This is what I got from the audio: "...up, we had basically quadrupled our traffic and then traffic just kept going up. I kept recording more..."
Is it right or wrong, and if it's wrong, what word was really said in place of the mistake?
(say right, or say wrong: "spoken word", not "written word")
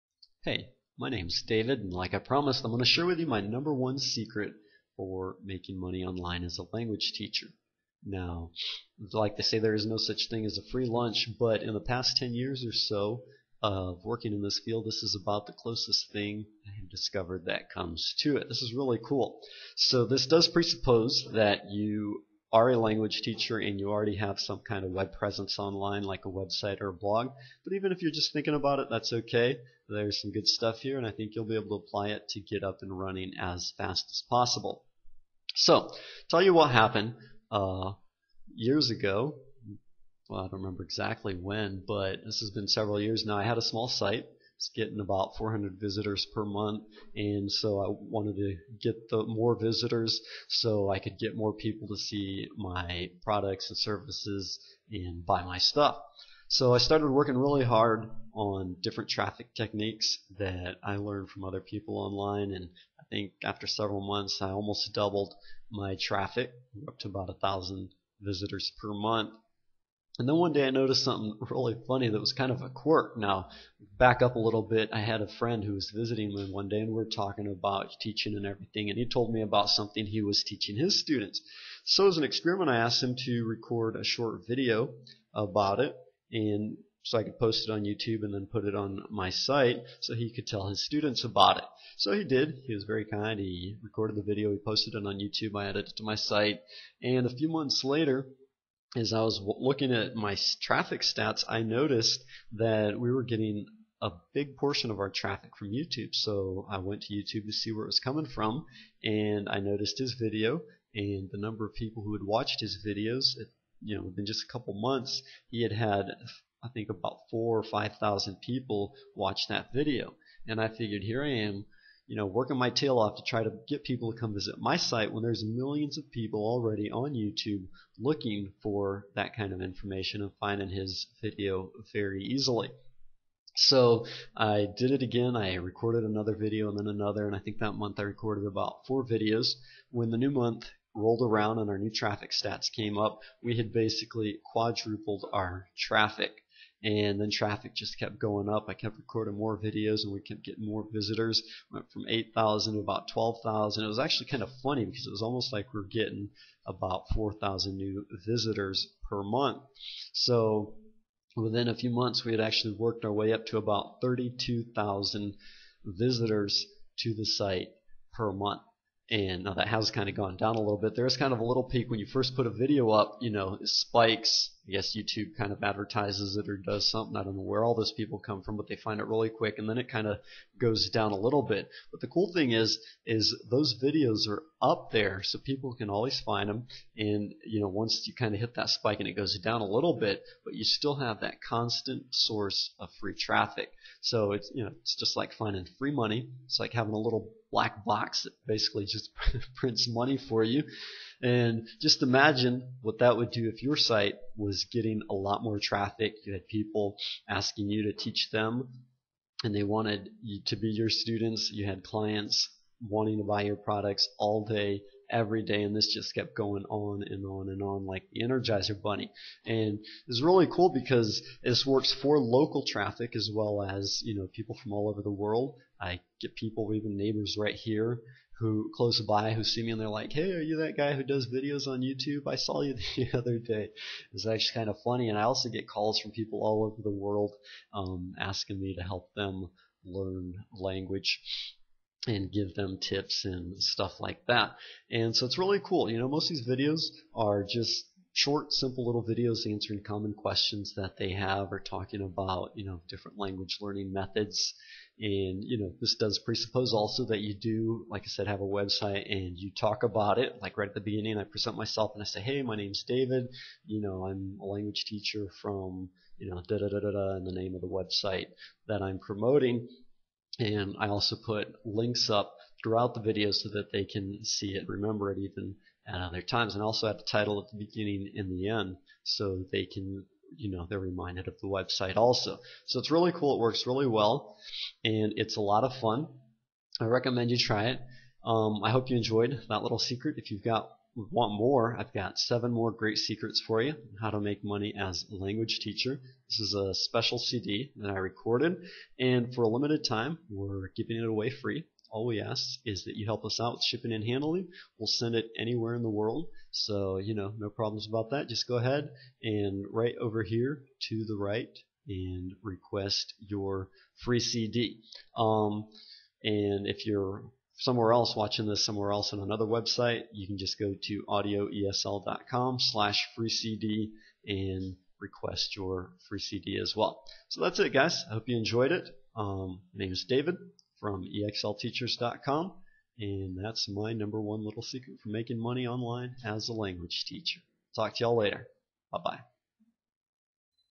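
right.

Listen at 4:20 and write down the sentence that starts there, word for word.
Like right at the beginning, I present myself and I say, hey, my name's David.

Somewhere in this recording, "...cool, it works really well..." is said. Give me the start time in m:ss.
4:43.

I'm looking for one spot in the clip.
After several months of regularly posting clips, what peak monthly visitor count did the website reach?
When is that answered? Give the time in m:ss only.
2:44.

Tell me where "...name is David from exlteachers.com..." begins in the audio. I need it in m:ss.
5:29.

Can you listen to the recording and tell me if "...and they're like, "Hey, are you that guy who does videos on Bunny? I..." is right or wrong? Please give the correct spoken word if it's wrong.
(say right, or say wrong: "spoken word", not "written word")
wrong: "YouTube", not "Bunny".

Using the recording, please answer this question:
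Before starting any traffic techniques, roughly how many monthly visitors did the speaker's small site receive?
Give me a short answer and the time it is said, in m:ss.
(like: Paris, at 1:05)
400, at 0:45.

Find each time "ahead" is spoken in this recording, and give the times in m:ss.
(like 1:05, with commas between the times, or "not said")
5:08.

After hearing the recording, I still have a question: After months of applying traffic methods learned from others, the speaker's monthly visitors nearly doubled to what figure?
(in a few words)
1,000.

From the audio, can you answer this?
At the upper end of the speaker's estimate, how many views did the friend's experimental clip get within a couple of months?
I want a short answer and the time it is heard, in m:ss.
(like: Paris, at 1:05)
5,000, at 1:57.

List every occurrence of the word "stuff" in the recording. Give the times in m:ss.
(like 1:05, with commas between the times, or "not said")
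0:30, 0:55, 4:03.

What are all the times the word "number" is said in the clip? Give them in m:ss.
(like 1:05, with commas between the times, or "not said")
0:03, 1:51, 5:33.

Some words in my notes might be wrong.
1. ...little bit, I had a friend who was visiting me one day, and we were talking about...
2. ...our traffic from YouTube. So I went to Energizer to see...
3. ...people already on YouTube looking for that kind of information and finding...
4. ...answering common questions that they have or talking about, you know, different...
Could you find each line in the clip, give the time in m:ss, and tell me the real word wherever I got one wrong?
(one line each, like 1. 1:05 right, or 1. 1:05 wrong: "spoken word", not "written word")
1. 1:14 right
2. 1:44 wrong: "YouTube", not "Energizer"
3. 2:06 right
4. 4:09 right.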